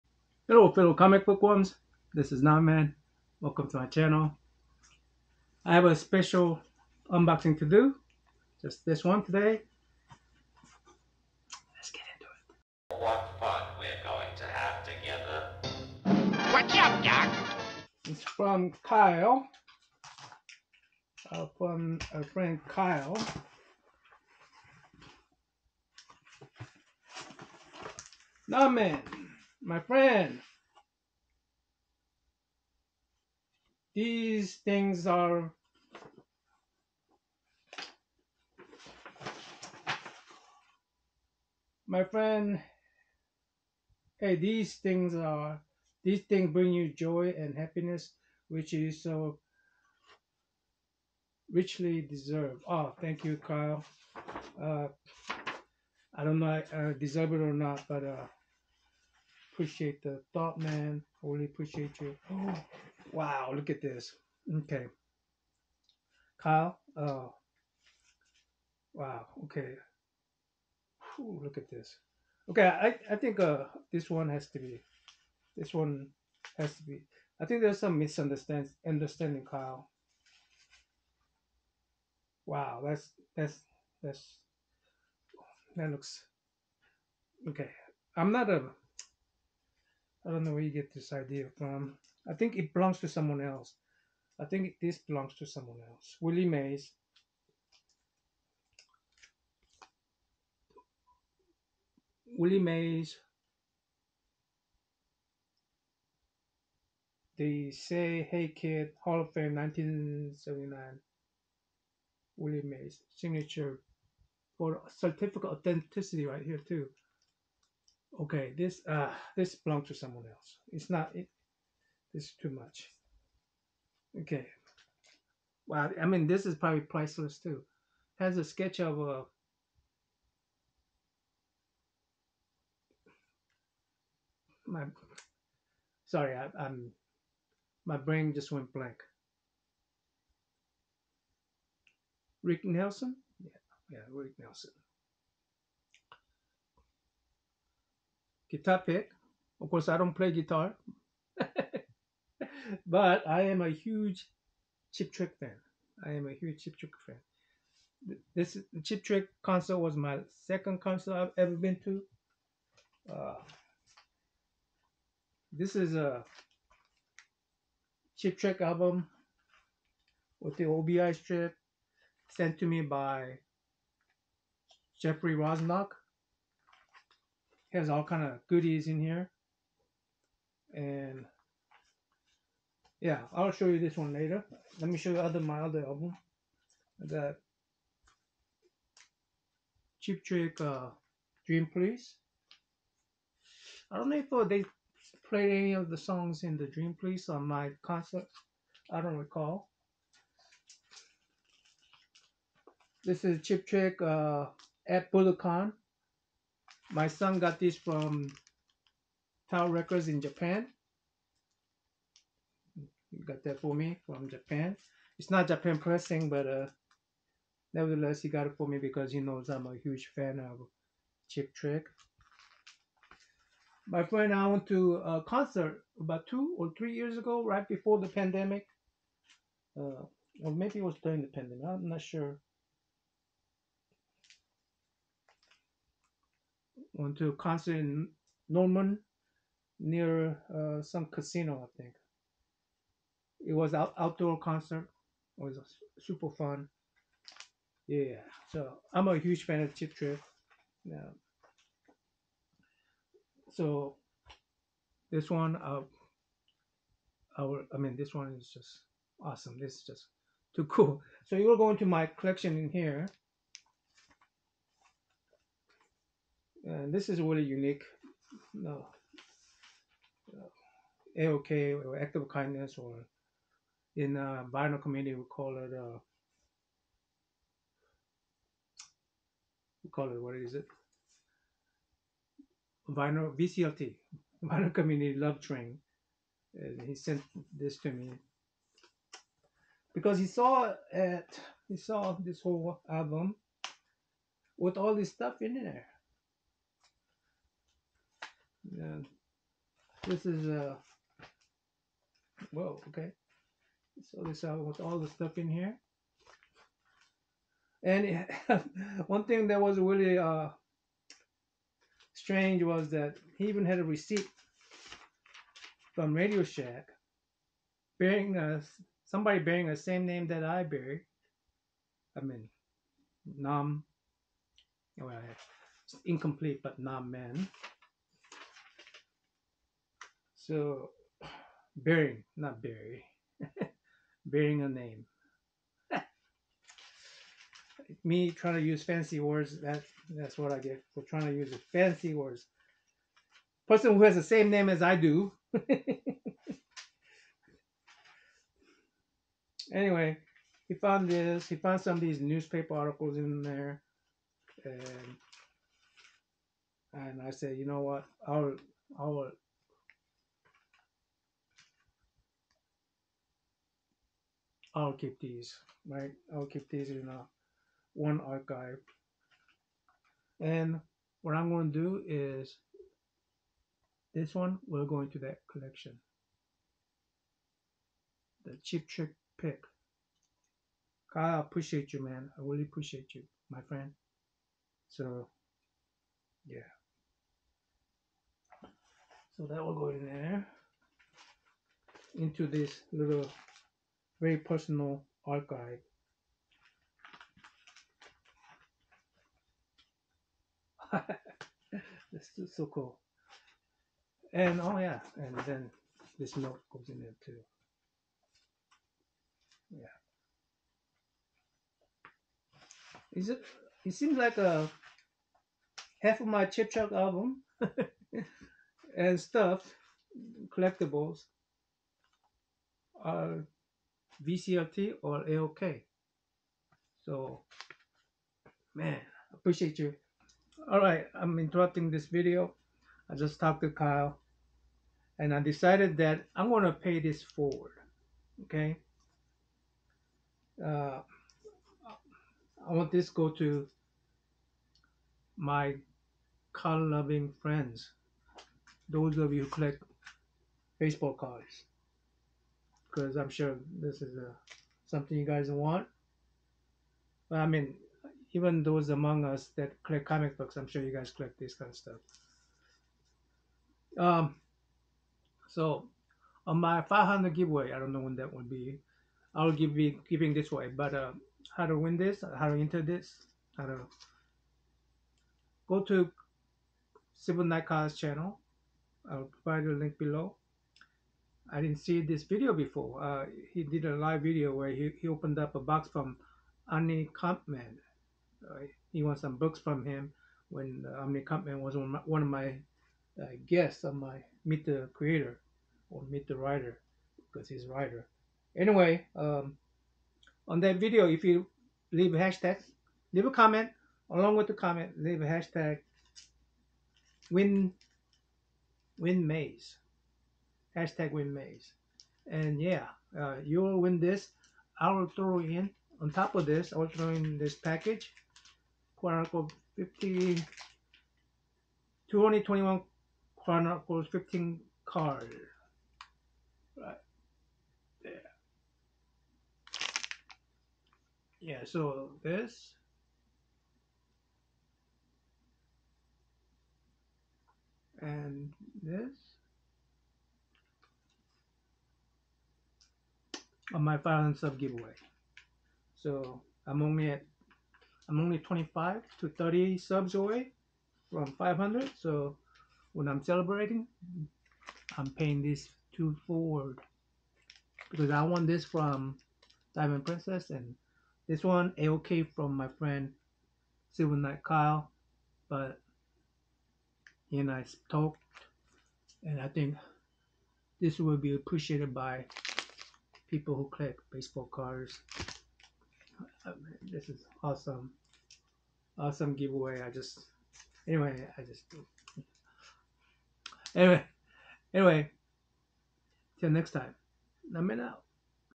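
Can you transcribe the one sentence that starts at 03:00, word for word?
And yeah, I'll show you this one later.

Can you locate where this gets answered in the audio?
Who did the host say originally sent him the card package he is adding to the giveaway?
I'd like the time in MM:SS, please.
09:19.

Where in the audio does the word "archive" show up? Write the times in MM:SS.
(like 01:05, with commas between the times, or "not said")
06:08, 06:35.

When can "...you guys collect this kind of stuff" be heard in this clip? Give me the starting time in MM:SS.
07:40.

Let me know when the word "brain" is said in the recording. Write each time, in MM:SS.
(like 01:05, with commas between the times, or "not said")
02:17.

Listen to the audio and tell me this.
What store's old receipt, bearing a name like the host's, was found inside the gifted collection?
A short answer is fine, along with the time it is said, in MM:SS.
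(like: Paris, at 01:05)
Radio Shack, at 05:16.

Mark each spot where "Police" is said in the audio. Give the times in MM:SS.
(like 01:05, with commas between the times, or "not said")
03:11, 03:16.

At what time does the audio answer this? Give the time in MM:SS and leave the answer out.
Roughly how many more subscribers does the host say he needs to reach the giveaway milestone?
09:08.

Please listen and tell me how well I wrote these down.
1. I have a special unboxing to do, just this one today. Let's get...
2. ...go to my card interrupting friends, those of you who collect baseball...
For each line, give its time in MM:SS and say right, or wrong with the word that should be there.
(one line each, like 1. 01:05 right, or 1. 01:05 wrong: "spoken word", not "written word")
1. 00:05 right
2. 07:23 wrong: "loving", not "interrupting".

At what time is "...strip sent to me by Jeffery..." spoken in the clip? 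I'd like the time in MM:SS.
02:51.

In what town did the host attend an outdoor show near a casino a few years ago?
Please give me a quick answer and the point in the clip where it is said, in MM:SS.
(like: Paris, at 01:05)
Norman, at 03:58.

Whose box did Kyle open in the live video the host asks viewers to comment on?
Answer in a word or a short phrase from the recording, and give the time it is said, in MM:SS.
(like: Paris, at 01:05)
Annie Kampman, at 08:06.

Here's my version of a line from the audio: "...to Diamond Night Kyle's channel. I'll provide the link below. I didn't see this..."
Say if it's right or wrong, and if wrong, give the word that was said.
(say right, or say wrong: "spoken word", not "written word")
wrong: "Silver", not "Diamond".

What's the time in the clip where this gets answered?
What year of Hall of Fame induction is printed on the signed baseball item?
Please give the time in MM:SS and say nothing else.
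01:49.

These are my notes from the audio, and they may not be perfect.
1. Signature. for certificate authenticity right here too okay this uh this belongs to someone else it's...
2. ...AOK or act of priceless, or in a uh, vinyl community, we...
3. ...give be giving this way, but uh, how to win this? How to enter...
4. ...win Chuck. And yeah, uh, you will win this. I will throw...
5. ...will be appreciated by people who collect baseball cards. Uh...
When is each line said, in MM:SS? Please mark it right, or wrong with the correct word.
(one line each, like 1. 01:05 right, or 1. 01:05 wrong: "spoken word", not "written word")
1. 01:53 right
2. 04:31 wrong: "kindness", not "priceless"
3. 07:49 right
4. 08:31 wrong: "Mays", not "Chuck"
5. 09:30 right.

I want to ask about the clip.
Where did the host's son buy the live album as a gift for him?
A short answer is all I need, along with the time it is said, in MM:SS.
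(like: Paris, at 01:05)
Tower Records, at 03:29.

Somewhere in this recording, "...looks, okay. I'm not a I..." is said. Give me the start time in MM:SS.
01:25.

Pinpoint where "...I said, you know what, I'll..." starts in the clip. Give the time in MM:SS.
05:57.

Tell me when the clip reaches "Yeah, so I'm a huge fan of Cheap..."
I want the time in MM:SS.
04:07.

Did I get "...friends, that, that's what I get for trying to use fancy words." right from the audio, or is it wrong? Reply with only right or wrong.
wrong.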